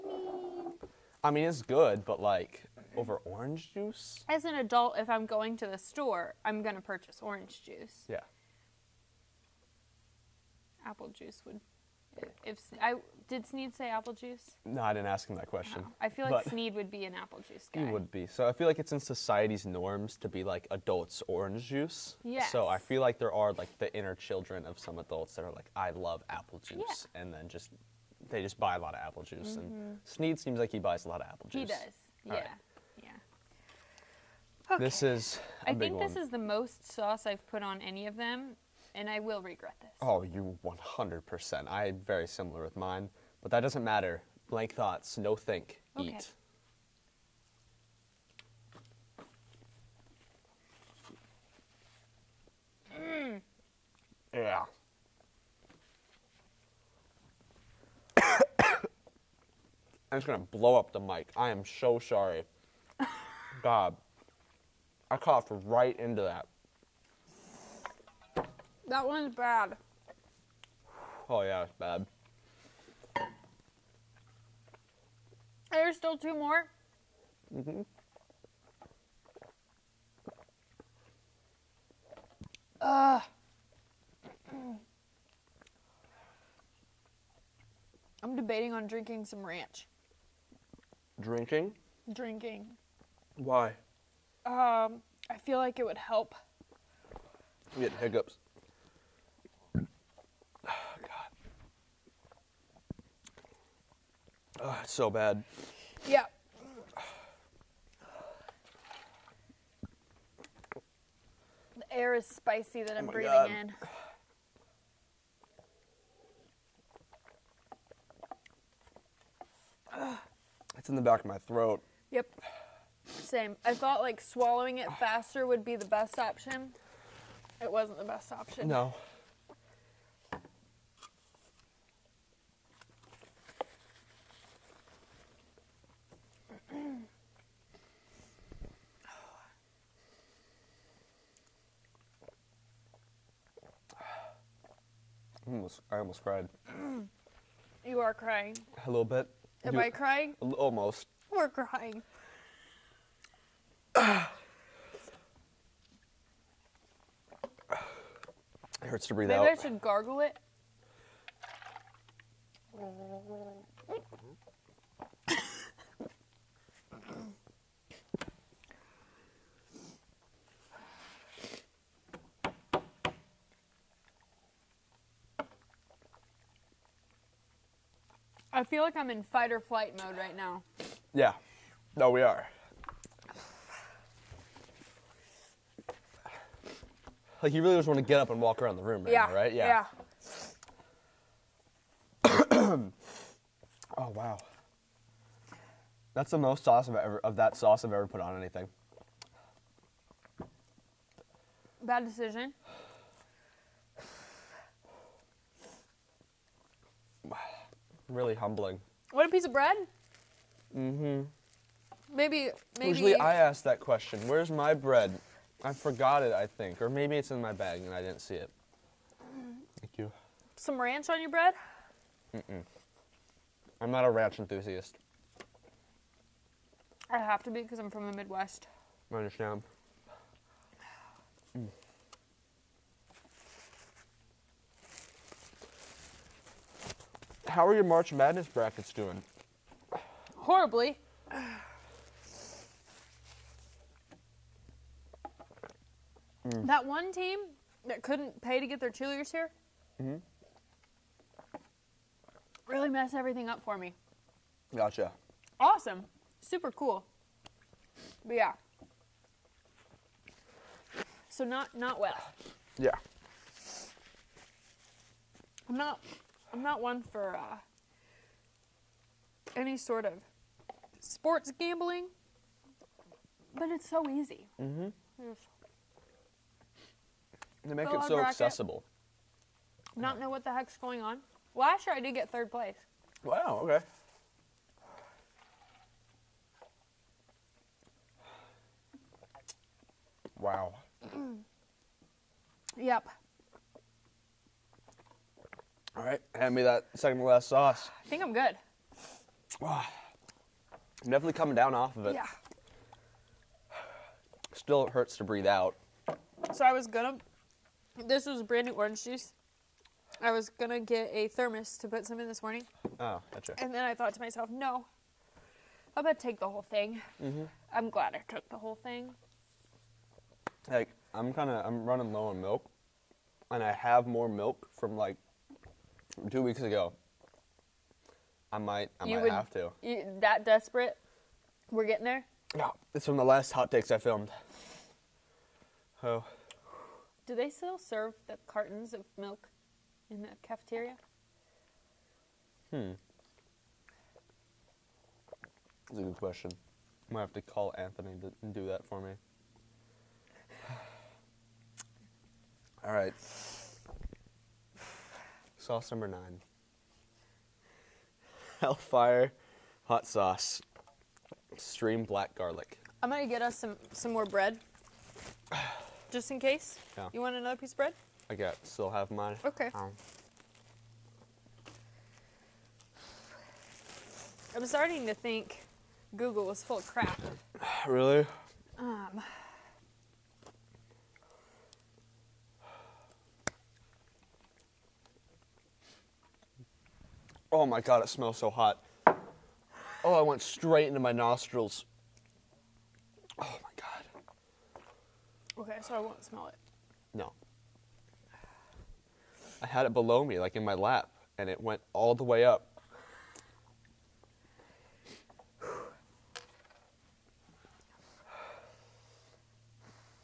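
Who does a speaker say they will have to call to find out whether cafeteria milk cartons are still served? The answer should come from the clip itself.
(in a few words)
Anthony.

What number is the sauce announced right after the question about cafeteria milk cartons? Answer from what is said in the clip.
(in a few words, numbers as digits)
9.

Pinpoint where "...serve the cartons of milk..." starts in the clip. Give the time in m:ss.
5:37.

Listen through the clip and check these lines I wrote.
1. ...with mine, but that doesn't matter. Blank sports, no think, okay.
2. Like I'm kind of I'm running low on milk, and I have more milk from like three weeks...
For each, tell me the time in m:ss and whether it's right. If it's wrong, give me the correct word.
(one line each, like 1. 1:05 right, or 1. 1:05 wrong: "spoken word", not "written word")
1. 0:42 wrong: "thoughts", not "sports"
2. 5:20 wrong: "two", not "three".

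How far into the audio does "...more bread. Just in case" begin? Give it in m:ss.
6:04.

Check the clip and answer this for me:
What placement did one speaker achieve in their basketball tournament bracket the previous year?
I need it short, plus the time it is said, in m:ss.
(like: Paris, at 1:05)
third place, at 4:42.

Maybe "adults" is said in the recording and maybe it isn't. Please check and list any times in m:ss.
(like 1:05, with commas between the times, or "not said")
0:04, 0:20, 0:24.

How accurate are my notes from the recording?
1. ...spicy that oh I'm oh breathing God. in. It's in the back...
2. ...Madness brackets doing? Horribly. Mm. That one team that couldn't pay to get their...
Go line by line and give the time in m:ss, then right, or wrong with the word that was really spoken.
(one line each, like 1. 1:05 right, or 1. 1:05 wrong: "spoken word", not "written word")
1. 1:52 right
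2. 3:58 right.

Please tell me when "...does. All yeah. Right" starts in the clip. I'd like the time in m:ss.
0:31.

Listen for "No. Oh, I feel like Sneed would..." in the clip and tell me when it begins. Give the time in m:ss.
0:15.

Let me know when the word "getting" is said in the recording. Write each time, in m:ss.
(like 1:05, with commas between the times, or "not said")
1:37, 5:31.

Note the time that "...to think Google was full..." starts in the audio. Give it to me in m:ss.
6:15.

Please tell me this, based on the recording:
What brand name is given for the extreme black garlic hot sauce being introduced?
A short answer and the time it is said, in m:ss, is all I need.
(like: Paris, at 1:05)
Hellfire, at 5:58.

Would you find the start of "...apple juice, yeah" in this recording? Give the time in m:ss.
0:26.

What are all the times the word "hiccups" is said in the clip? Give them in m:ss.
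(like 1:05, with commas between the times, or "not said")
1:37.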